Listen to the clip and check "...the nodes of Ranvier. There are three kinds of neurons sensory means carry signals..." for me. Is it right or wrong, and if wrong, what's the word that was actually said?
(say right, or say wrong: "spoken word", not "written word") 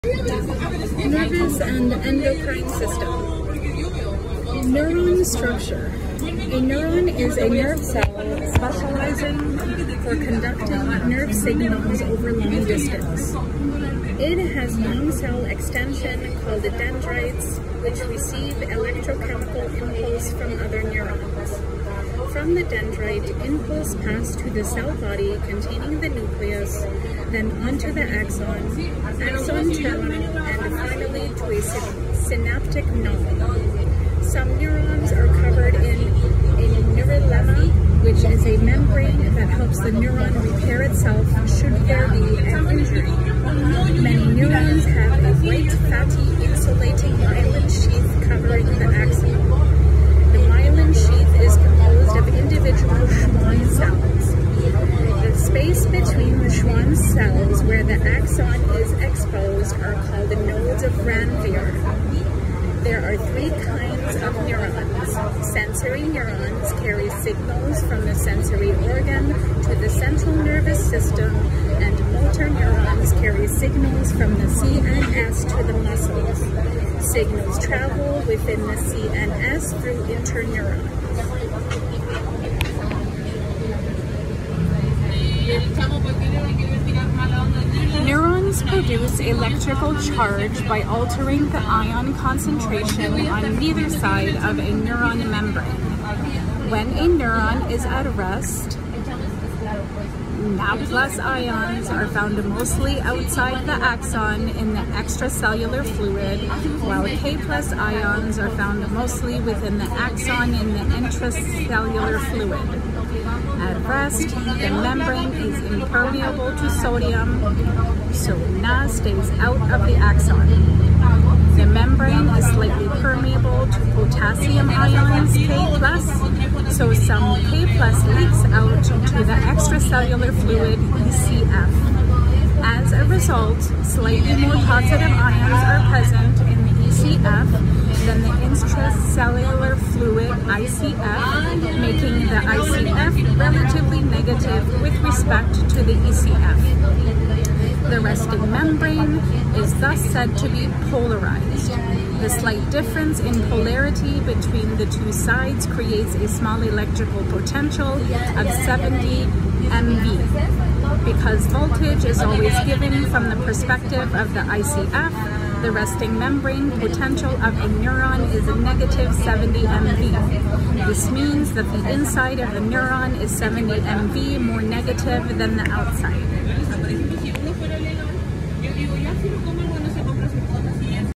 wrong: "neurons", not "means".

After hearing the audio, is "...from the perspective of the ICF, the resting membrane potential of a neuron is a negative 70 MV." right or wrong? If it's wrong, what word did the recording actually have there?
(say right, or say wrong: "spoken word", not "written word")
right.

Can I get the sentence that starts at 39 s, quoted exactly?
the neuron repair itself should there be an injury.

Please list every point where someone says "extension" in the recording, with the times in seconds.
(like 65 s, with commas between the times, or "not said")
15 s.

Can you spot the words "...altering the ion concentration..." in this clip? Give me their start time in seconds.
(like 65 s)
90 s.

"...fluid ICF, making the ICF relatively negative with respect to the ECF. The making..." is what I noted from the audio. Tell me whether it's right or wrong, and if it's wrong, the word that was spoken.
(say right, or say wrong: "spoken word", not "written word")
wrong: "resting", not "making".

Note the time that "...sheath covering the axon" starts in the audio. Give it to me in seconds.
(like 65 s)
47 s.